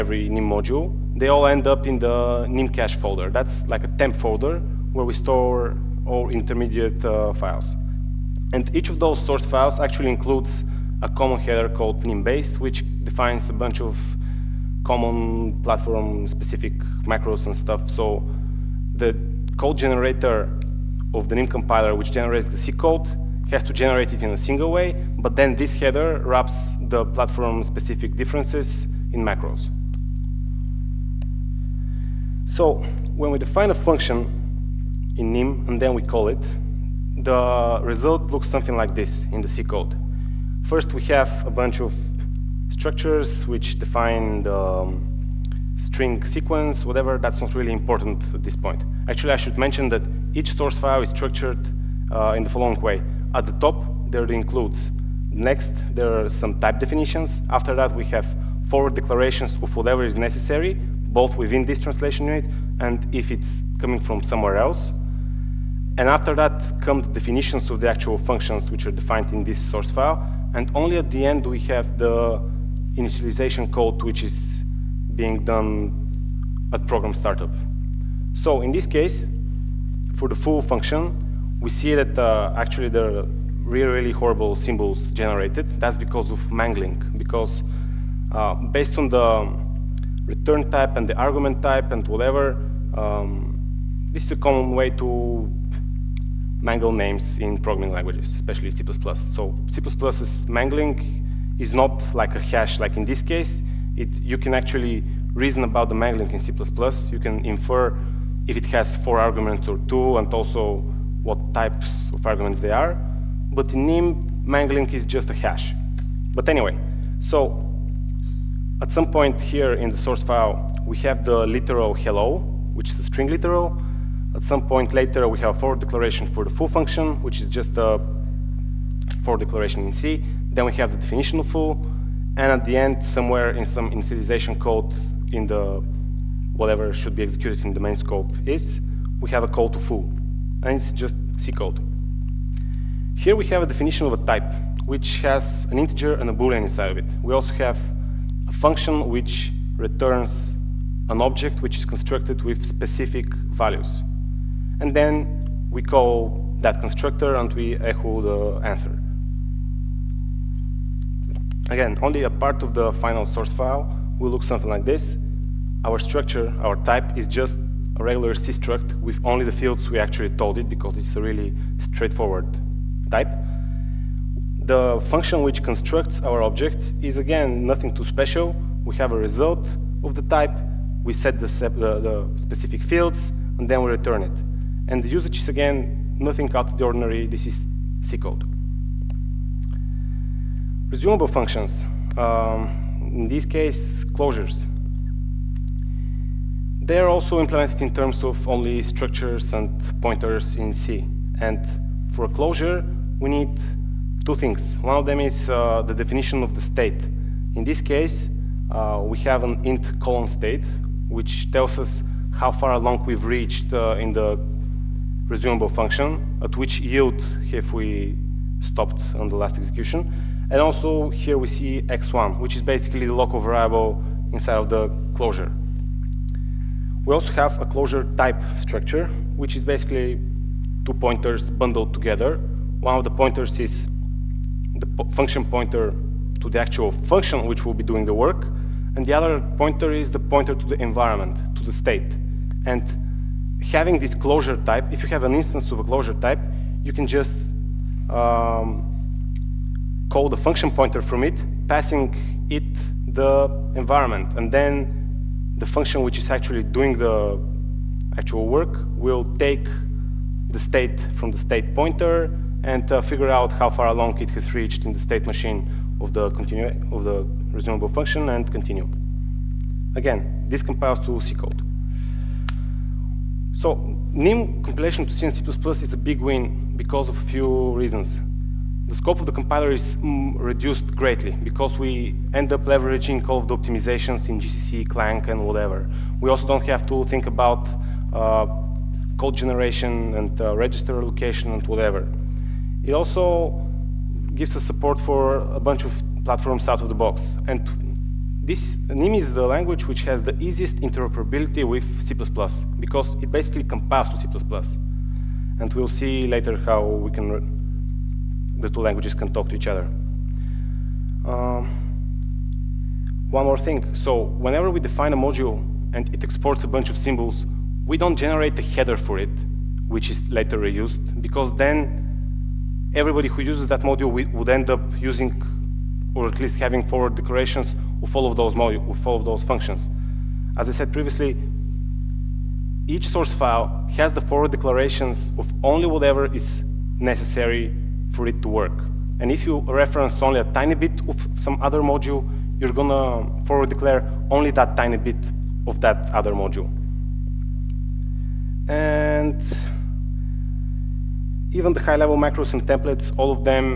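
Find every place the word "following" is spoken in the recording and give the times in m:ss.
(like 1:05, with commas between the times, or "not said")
0:52.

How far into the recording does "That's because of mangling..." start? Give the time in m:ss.
1:25.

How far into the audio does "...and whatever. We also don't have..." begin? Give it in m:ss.
4:45.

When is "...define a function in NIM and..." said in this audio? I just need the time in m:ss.
0:33.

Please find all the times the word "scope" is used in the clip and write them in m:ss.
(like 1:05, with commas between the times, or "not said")
2:17, 4:38.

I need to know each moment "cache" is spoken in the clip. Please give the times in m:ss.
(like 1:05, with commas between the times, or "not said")
0:02.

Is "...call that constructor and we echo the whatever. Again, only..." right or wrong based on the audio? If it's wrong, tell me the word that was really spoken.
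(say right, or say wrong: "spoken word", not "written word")
wrong: "answer", not "whatever".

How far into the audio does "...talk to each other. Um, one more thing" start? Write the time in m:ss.
5:09.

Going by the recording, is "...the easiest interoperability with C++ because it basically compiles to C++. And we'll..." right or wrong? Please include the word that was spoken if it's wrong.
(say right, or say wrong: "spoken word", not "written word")
right.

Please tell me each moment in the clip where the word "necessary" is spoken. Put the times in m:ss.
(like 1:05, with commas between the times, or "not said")
1:00, 5:36.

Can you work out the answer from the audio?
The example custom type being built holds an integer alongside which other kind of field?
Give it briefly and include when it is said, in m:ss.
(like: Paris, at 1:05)
A boolean, at 2:26.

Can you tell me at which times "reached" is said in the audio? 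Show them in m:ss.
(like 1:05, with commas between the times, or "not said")
3:33, 4:24.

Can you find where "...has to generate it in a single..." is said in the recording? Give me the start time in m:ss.
0:23.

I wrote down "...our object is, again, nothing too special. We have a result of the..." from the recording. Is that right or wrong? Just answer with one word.
right.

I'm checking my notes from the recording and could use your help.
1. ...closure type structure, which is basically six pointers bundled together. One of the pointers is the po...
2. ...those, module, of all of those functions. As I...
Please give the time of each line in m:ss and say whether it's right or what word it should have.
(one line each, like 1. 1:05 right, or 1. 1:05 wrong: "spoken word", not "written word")
1. 3:47 wrong: "two", not "six"
2. 5:28 right.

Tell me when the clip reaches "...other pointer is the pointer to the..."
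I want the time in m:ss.
3:59.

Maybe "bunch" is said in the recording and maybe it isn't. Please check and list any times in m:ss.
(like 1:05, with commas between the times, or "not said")
0:13, 0:41, 4:55, 5:16.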